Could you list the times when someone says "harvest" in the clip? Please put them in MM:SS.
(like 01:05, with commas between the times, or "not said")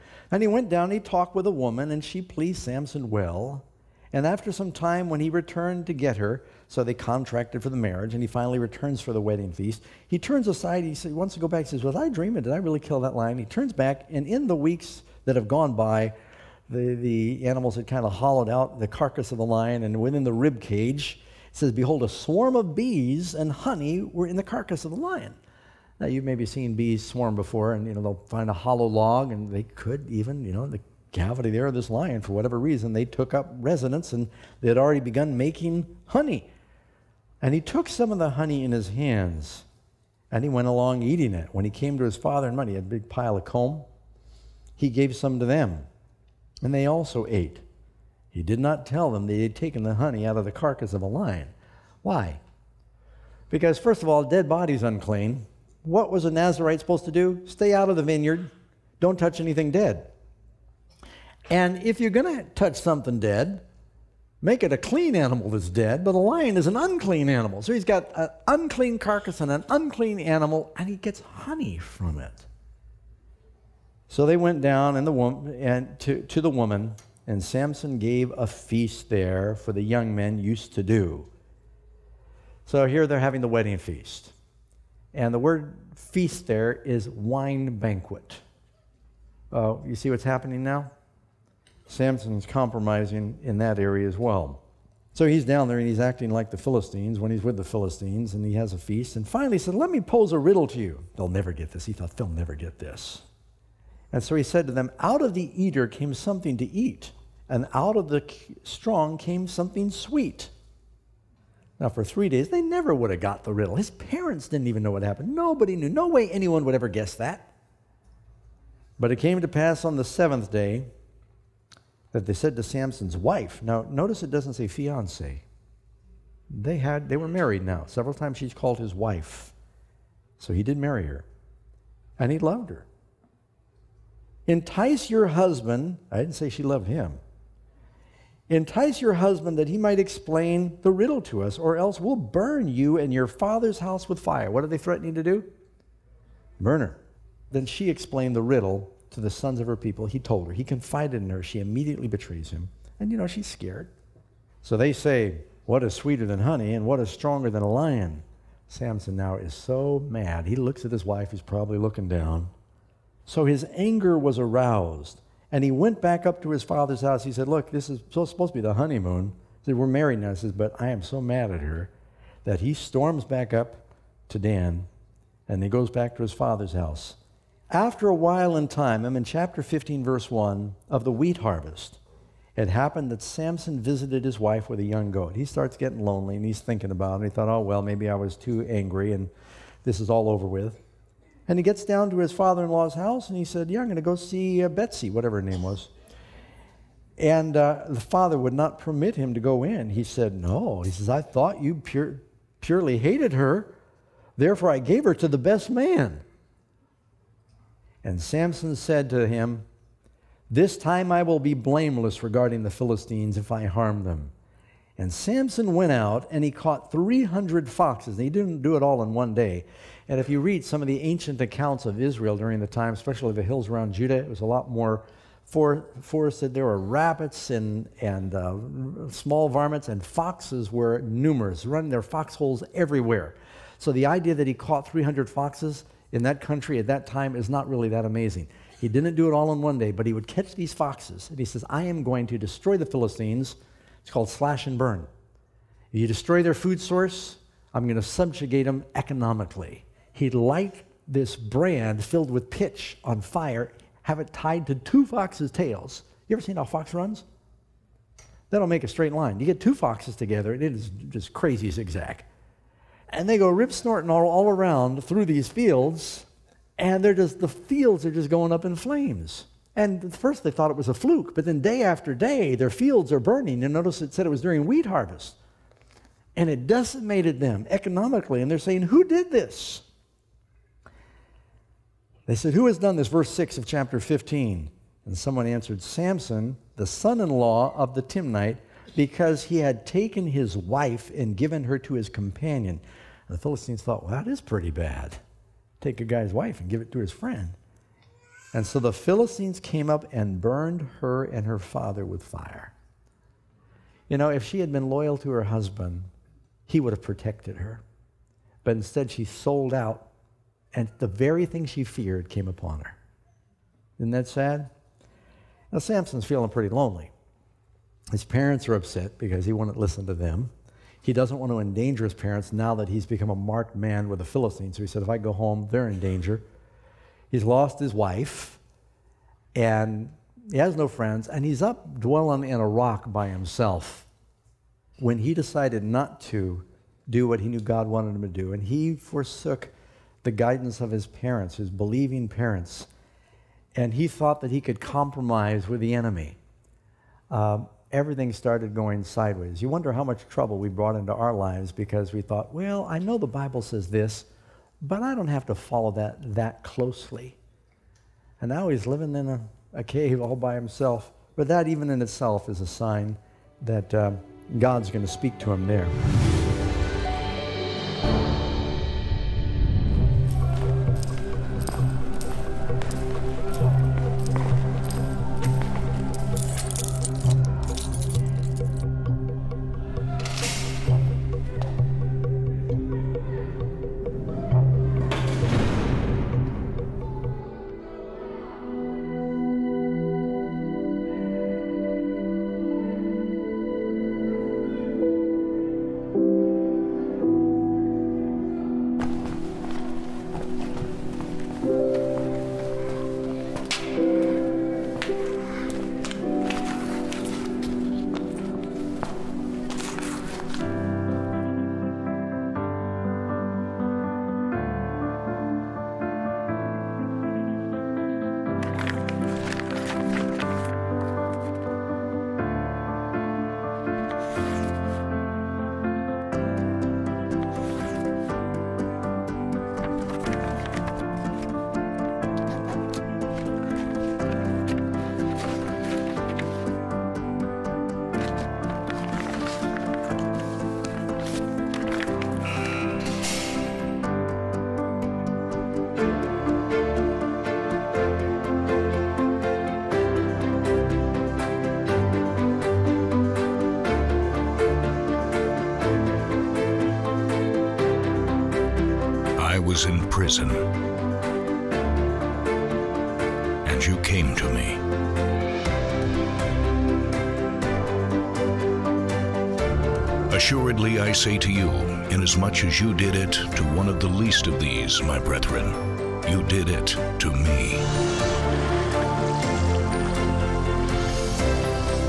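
03:01, 04:34.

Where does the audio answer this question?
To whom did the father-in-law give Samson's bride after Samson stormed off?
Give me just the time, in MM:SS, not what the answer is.
03:25.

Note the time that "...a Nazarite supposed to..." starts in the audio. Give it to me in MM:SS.
00:56.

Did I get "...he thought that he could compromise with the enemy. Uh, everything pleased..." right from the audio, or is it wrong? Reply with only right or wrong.
wrong.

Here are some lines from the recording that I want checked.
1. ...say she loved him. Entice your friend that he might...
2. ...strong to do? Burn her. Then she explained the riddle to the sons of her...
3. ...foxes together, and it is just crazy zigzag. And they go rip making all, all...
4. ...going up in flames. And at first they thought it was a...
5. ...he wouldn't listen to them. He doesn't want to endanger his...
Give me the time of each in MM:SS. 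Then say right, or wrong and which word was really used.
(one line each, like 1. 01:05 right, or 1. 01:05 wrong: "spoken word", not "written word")
1. 02:16 wrong: "husband", not "friend"
2. 02:24 wrong: "threatening", not "strong"
3. 04:19 wrong: "snorting", not "making"
4. 04:28 right
5. 05:19 right.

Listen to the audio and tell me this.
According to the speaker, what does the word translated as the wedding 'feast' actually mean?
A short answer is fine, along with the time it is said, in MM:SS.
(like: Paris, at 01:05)
Wine banquet, at 01:27.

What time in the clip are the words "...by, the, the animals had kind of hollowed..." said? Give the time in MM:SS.
00:15.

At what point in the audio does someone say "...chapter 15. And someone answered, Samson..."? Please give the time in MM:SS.
04:43.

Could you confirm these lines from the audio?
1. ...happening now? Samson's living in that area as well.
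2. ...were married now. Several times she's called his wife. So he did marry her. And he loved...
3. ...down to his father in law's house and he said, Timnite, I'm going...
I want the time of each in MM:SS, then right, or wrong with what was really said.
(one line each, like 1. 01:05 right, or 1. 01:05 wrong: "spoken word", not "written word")
1. 01:30 wrong: "compromising", not "living"
2. 02:07 right
3. 03:11 wrong: "Yeah", not "Timnite".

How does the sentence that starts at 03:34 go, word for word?
And Samson went out and he caught 300 foxes.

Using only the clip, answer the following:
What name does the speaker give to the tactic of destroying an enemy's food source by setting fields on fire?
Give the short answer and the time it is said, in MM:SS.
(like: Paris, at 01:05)
Slash and burn, at 04:04.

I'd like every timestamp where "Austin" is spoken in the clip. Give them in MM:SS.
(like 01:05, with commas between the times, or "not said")
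not said.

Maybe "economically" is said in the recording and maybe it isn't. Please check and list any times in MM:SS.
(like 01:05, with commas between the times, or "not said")
04:08, 04:37.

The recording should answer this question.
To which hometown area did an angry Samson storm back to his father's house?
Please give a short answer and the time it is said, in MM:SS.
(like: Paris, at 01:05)
Dan, at 02:54.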